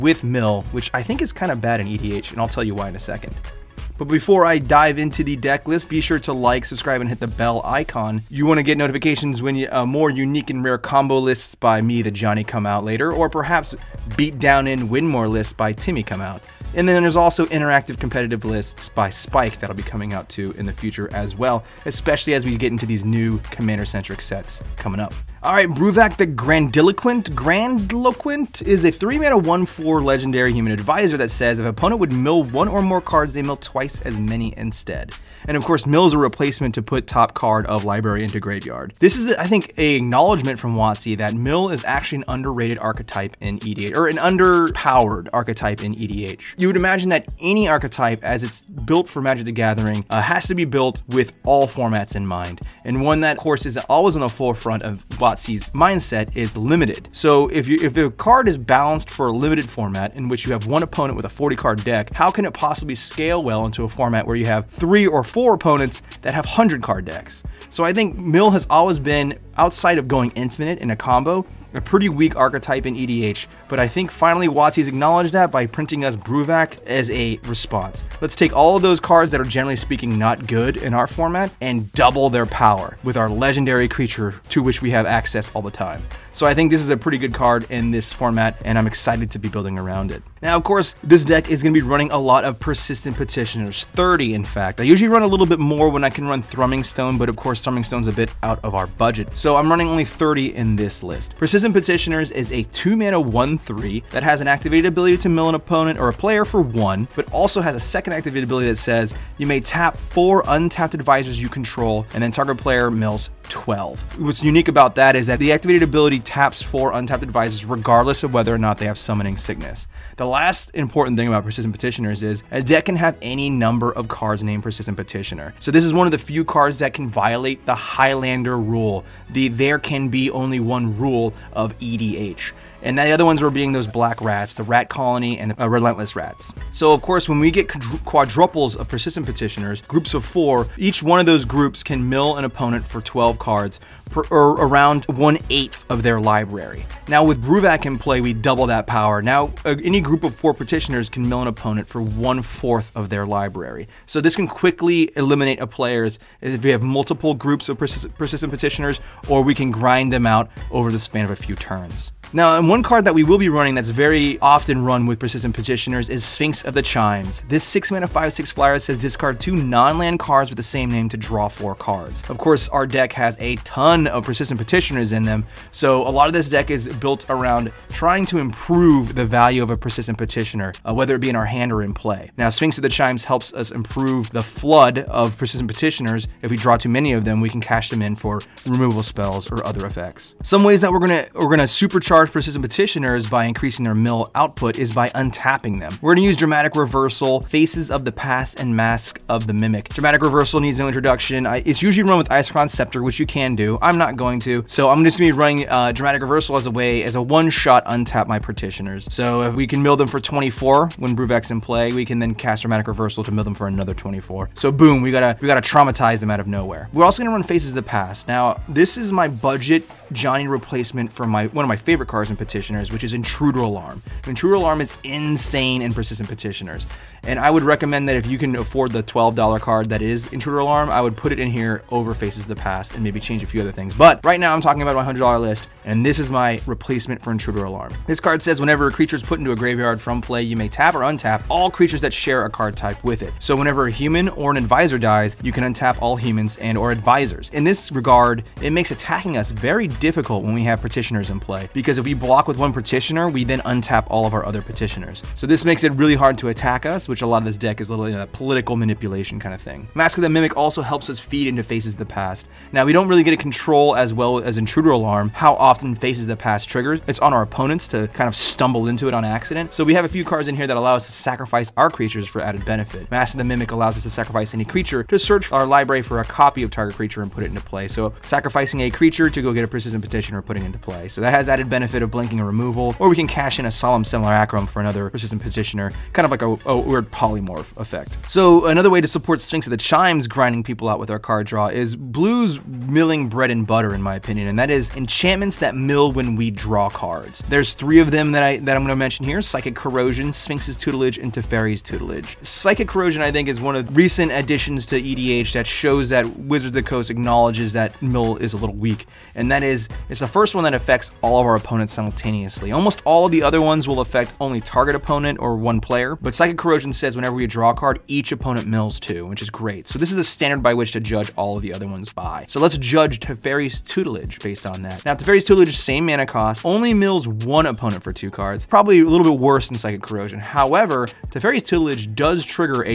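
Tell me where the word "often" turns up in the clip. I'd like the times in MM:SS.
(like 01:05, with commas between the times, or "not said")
02:44, 04:25.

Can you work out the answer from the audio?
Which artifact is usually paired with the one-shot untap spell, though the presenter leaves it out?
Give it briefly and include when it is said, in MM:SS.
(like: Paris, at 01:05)
Isochron Scepter, at 03:22.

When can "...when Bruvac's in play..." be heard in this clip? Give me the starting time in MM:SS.
03:30.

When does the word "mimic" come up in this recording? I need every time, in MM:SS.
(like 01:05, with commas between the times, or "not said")
03:19, 04:20, 04:33.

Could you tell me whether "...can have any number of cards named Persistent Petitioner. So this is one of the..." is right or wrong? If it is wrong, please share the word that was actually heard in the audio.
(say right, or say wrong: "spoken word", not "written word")
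right.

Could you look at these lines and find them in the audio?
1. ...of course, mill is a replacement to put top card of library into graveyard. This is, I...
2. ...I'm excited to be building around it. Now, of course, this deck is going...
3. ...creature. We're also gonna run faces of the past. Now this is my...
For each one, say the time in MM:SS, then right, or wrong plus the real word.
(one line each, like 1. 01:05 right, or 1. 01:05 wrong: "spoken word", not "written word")
1. 00:35 right
2. 01:28 right
3. 03:36 wrong: "nowhere", not "creature".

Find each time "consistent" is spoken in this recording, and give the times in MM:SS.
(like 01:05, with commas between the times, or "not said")
not said.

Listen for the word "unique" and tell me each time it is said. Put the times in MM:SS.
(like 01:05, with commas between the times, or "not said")
00:10, 01:54.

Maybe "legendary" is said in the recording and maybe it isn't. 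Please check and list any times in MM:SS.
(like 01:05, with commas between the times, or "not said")
00:30, 01:23.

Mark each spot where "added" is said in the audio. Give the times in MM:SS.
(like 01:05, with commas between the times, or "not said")
04:32, 04:41.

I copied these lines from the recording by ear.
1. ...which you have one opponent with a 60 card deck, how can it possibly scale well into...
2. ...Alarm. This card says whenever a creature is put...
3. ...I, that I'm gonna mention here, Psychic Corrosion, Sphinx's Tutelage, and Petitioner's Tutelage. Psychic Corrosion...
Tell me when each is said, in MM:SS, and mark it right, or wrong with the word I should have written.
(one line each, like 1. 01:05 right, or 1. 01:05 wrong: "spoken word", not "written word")
1. 01:00 wrong: "40", not "60"
2. 03:57 right
3. 04:58 wrong: "Teferi", not "Petitioner".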